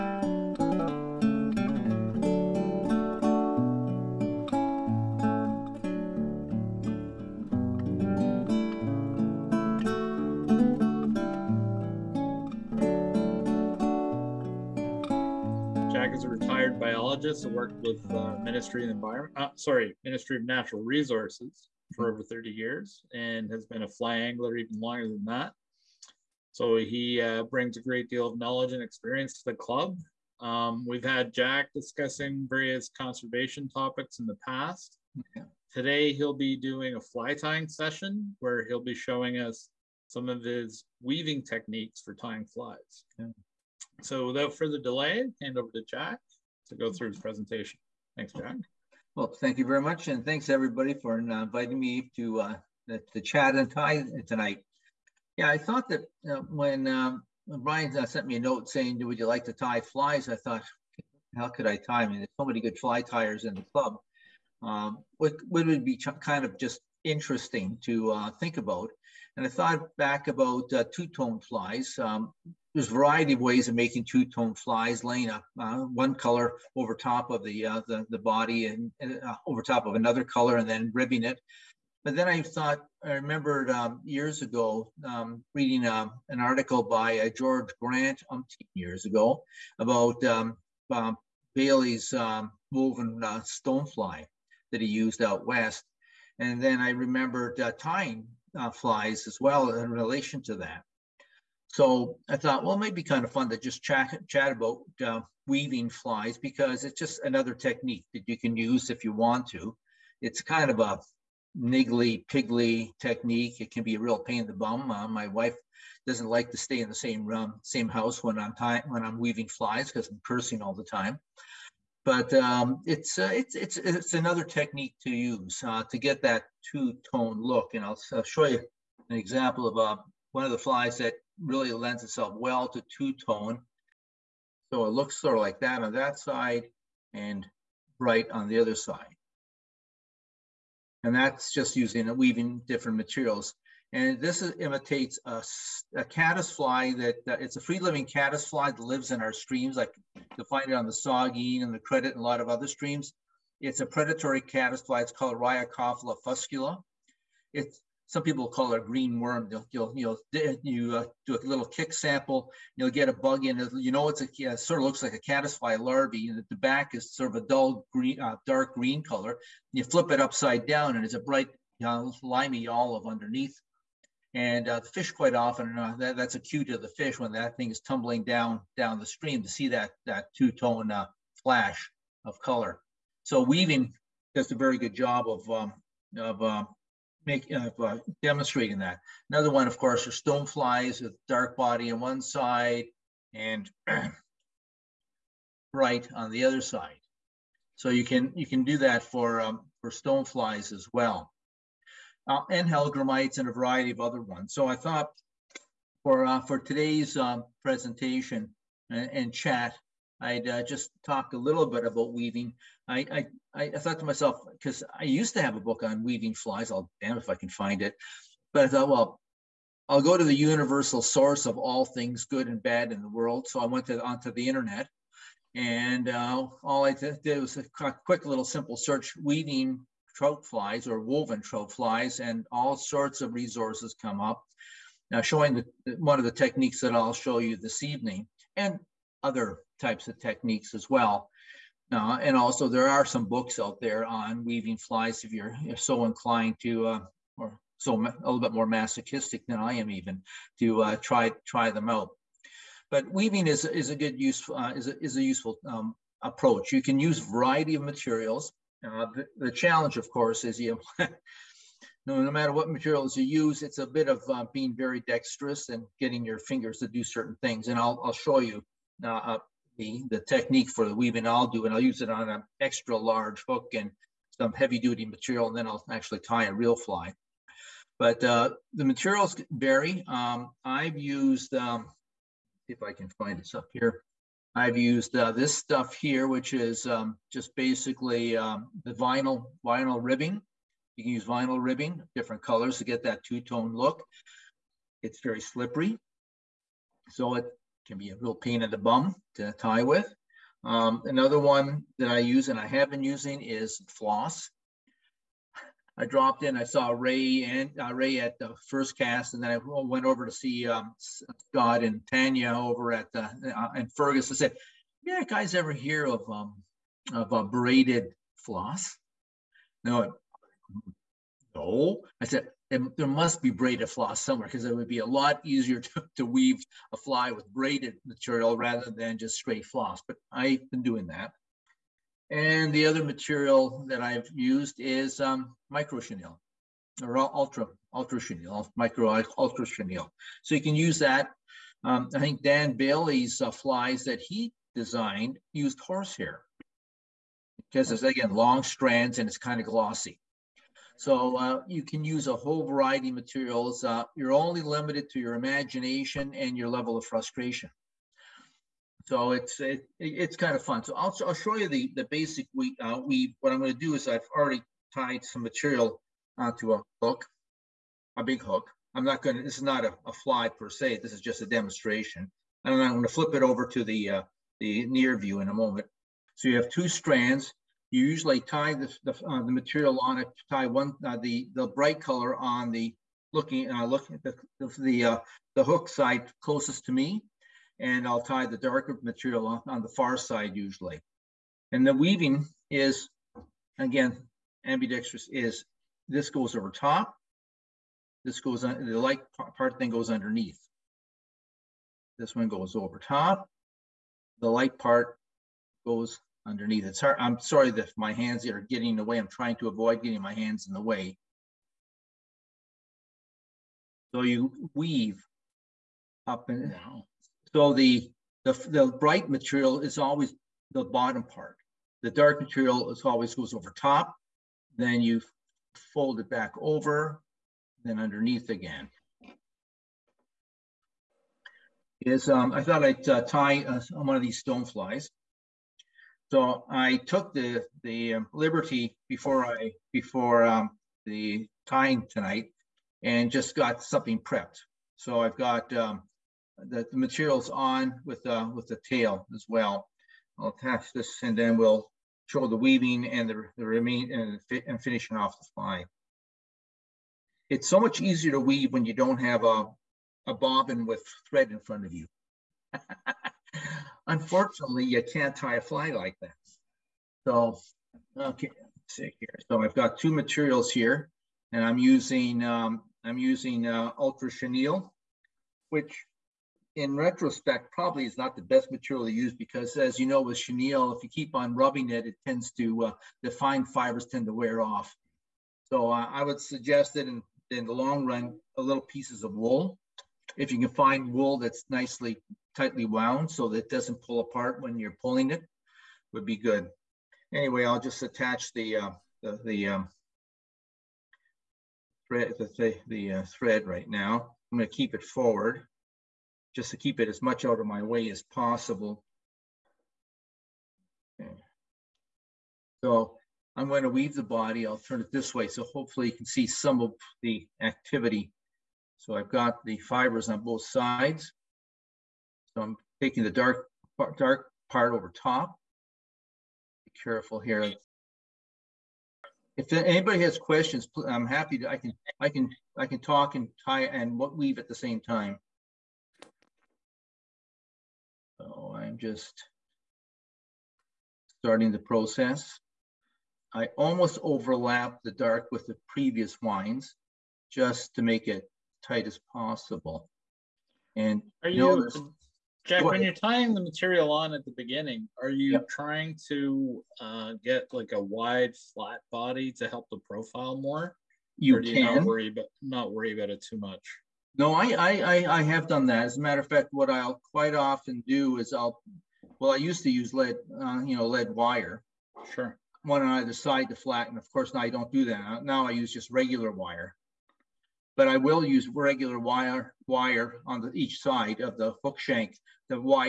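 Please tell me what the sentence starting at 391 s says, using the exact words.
And the weaving is again ambidextrous.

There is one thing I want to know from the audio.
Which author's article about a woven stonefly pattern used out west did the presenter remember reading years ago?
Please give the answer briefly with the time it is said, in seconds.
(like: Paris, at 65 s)
George Grant, at 87 s.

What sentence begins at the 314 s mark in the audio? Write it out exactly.
I said, "Yeah, guys, ever hear of um, of a braided floss?" No, no.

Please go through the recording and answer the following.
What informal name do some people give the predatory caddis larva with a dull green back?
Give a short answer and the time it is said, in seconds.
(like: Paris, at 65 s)
green worm, at 158 s.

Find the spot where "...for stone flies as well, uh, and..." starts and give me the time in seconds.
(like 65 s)
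199 s.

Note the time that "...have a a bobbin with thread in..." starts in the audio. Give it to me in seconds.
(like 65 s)
459 s.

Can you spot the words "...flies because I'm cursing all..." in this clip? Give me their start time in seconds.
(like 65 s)
119 s.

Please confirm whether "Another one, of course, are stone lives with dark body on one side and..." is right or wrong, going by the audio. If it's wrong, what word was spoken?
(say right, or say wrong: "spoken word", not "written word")
wrong: "flies", not "lives".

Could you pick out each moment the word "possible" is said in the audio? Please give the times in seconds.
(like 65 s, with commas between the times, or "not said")
508 s, 549 s.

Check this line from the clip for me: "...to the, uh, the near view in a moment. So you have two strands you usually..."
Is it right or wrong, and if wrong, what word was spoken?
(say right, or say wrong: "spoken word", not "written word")
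right.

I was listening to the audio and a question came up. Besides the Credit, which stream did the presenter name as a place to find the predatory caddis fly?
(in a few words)
Saugeen.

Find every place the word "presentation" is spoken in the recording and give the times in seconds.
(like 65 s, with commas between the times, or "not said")
47 s, 207 s.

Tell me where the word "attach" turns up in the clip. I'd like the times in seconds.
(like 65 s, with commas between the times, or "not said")
450 s, 498 s.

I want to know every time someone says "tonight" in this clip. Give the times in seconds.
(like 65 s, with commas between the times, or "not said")
54 s, 442 s.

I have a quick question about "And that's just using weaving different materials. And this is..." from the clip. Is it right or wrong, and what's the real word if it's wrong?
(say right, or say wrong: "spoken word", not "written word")
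right.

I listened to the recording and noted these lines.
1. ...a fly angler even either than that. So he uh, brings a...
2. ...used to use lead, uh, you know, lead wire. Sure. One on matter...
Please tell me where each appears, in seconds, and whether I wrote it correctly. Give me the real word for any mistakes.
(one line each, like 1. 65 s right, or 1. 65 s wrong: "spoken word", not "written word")
1. 23 s wrong: "longer", not "either"
2. 569 s wrong: "either", not "matter".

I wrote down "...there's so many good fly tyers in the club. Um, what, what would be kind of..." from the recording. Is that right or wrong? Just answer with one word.
right.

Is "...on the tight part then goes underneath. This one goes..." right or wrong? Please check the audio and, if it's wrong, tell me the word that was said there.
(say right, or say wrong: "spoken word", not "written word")
wrong: "light", not "tight".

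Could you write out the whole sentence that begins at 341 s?
Um, I think Dan Bailey's uh, flies that he designed used horsehair because it's again long strands and it's kind of glossy.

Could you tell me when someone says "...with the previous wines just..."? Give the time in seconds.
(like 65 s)
545 s.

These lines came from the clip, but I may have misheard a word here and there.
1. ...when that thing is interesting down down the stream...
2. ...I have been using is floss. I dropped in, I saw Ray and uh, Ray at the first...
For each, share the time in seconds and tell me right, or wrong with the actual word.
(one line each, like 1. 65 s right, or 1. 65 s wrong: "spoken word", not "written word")
1. 177 s wrong: "tumbling", not "interesting"
2. 302 s right.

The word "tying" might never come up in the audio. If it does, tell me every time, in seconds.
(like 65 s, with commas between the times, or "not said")
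37 s, 42 s, 97 s, 553 s.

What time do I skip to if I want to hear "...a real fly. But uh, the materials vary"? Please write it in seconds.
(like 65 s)
276 s.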